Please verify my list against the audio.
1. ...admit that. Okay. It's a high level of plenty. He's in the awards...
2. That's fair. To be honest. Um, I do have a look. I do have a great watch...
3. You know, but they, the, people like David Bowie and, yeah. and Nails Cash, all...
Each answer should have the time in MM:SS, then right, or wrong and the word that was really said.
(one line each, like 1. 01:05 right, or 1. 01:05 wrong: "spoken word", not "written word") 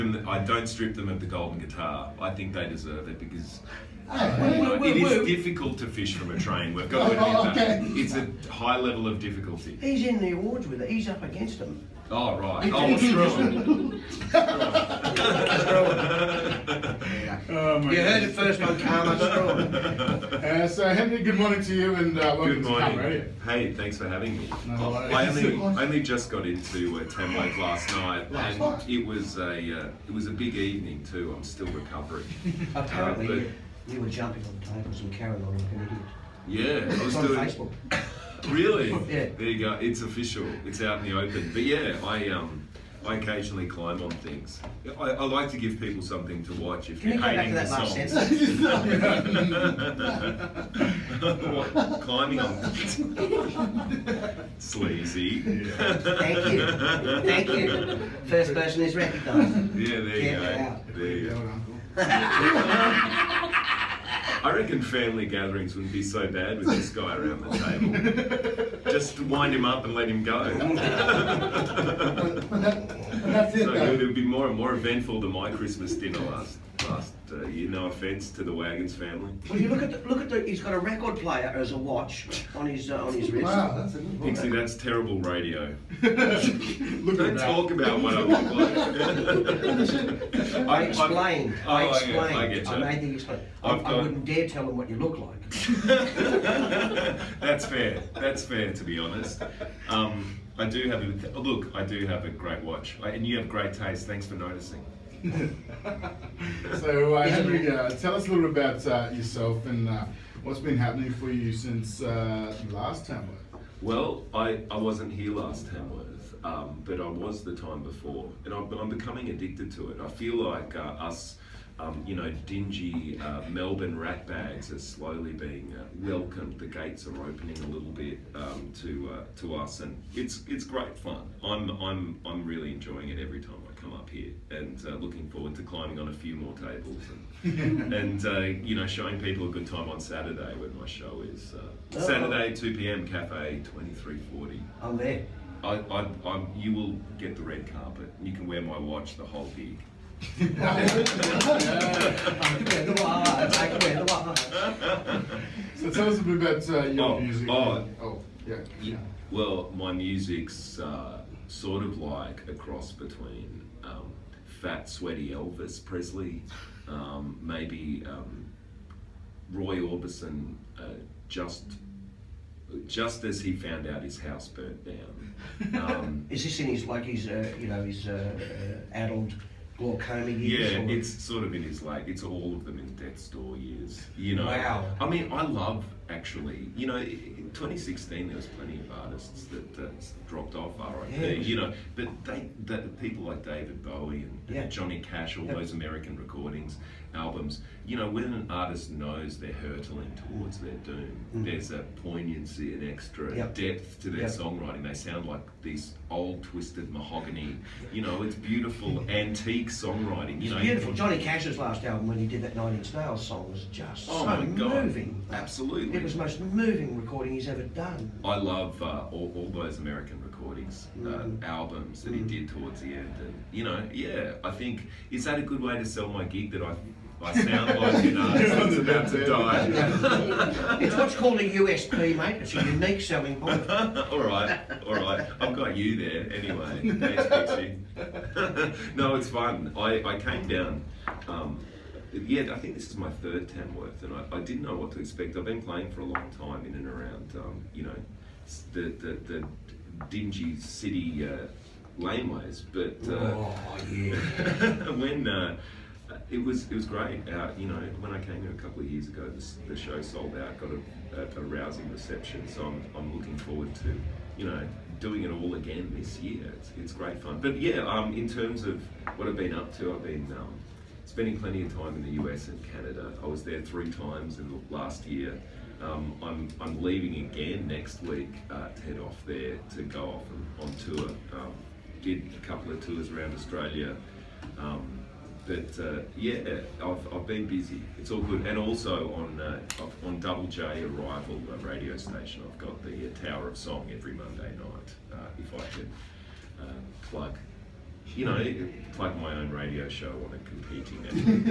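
1. 00:07 wrong: "difficulty", not "plenty"
2. 01:38 right
3. 03:11 wrong: "Johnny", not "Nails".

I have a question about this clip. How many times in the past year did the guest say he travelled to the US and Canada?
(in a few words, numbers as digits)
3.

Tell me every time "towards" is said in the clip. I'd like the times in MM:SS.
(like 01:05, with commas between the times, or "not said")
03:20, 03:42.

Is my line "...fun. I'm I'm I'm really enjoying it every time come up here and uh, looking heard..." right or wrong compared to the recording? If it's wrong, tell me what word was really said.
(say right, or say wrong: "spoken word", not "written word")
wrong: "forward", not "heard".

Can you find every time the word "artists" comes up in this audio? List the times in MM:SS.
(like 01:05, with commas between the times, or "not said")
03:09, 03:18.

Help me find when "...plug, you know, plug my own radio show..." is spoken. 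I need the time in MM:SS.
04:57.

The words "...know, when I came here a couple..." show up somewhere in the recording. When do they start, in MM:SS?
04:17.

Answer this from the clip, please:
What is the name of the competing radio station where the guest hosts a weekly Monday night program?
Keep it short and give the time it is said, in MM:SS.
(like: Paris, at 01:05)
Double J, at 04:50.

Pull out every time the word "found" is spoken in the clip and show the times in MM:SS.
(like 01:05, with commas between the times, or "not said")
02:53.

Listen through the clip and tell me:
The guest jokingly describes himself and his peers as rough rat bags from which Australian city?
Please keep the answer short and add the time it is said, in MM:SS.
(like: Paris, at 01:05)
Melbourne, at 02:03.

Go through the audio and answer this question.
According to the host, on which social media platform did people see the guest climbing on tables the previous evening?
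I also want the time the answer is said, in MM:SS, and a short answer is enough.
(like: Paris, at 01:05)
Facebook, at 00:37.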